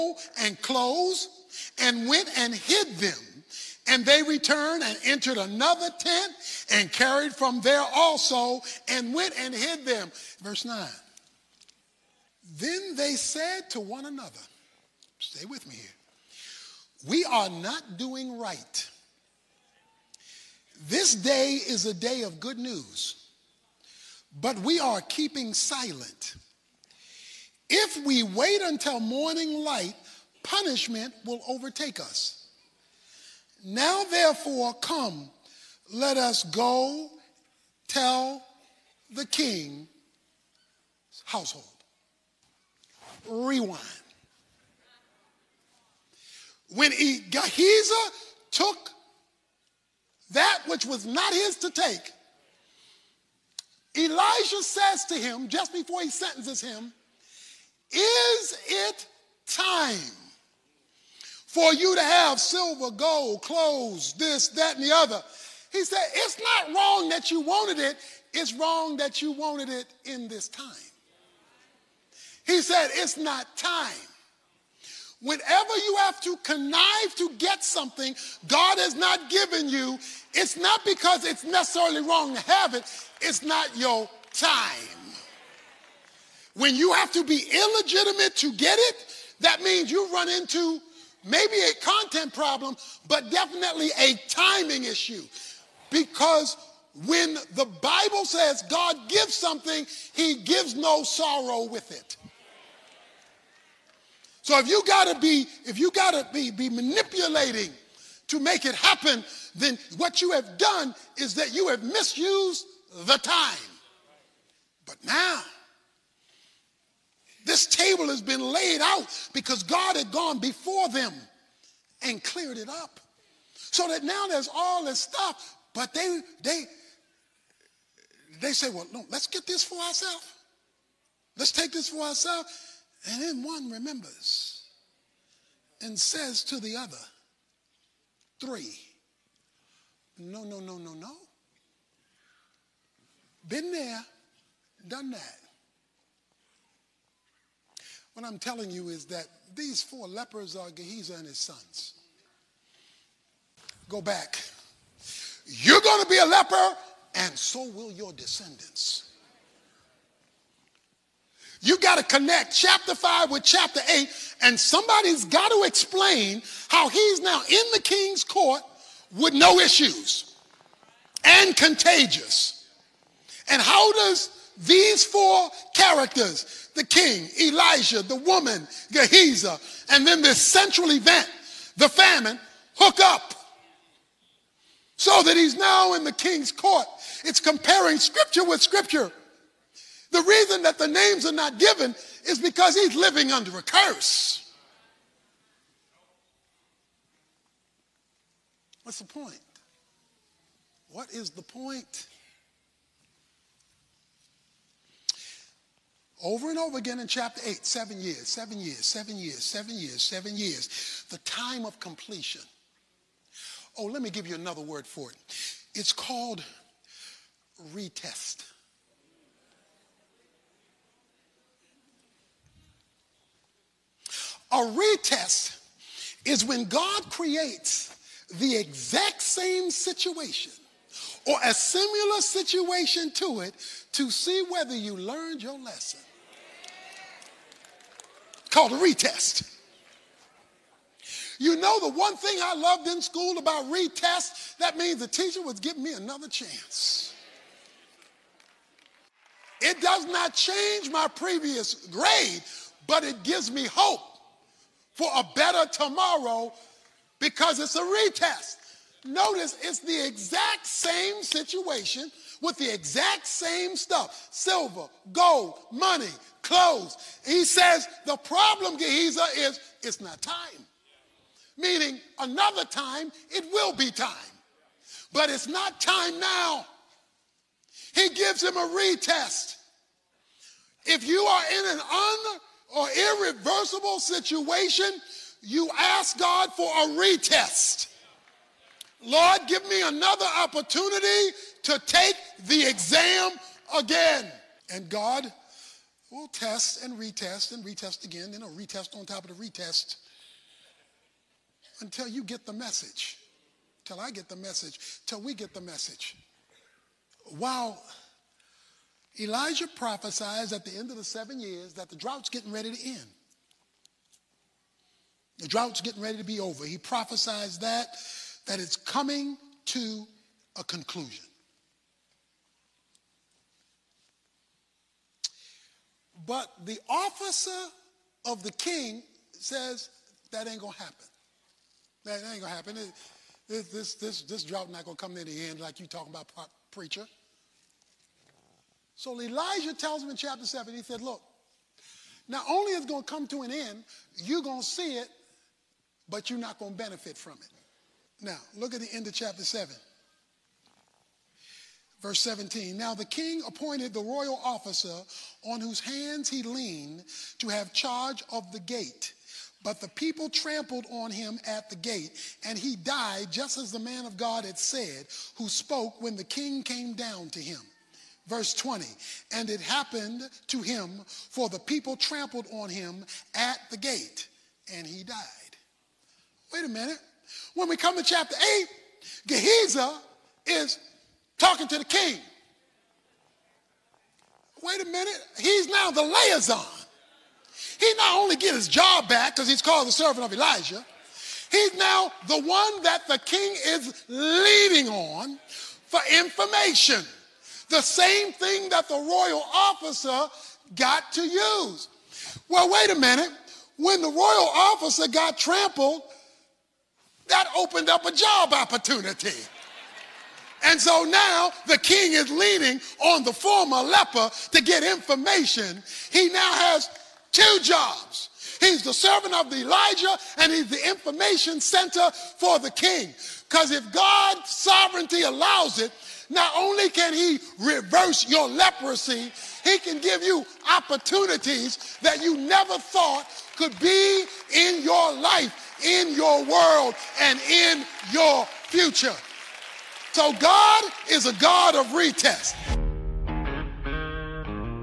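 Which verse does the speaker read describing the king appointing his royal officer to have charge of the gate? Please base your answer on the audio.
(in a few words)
Verse 17.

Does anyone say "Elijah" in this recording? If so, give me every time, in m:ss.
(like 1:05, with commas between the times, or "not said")
0:53, 2:57, 5:09, 5:39, 6:30, 6:59.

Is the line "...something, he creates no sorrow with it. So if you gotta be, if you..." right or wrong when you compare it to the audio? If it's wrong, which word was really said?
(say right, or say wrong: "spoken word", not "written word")
wrong: "gives", not "creates".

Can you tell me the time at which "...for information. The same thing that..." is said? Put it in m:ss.
6:35.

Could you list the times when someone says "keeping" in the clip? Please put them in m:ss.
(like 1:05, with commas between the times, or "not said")
0:25.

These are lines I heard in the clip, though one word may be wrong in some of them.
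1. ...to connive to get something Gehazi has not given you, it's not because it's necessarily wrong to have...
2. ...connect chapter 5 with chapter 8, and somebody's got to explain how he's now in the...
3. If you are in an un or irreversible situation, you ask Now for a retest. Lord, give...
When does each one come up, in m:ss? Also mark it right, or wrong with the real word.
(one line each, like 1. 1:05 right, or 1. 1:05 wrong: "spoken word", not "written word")
1. 1:16 wrong: "God", not "Gehazi"
2. 2:42 right
3. 4:40 wrong: "God", not "Now".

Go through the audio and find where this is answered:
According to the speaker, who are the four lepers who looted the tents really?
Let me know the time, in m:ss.
2:30.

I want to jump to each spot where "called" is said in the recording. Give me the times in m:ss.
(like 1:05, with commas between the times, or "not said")
3:35, 3:58, 6:29.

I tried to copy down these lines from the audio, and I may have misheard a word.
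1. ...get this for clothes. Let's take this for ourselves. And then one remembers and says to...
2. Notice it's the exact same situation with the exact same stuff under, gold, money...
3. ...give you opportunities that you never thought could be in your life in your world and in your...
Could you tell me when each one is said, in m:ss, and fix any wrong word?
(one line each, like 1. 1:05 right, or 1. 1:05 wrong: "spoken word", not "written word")
1. 2:09 wrong: "ourselves", not "clothes"
2. 4:19 wrong: "silver", not "under"
3. 7:10 right.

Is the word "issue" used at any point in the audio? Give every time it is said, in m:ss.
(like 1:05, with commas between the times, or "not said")
1:34, 2:49.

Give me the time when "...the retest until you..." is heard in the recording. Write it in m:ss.
4:59.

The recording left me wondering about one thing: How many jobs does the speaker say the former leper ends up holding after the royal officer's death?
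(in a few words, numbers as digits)
2.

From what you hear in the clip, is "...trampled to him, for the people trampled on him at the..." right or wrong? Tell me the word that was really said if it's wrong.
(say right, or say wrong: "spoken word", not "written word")
wrong: "happened", not "trampled".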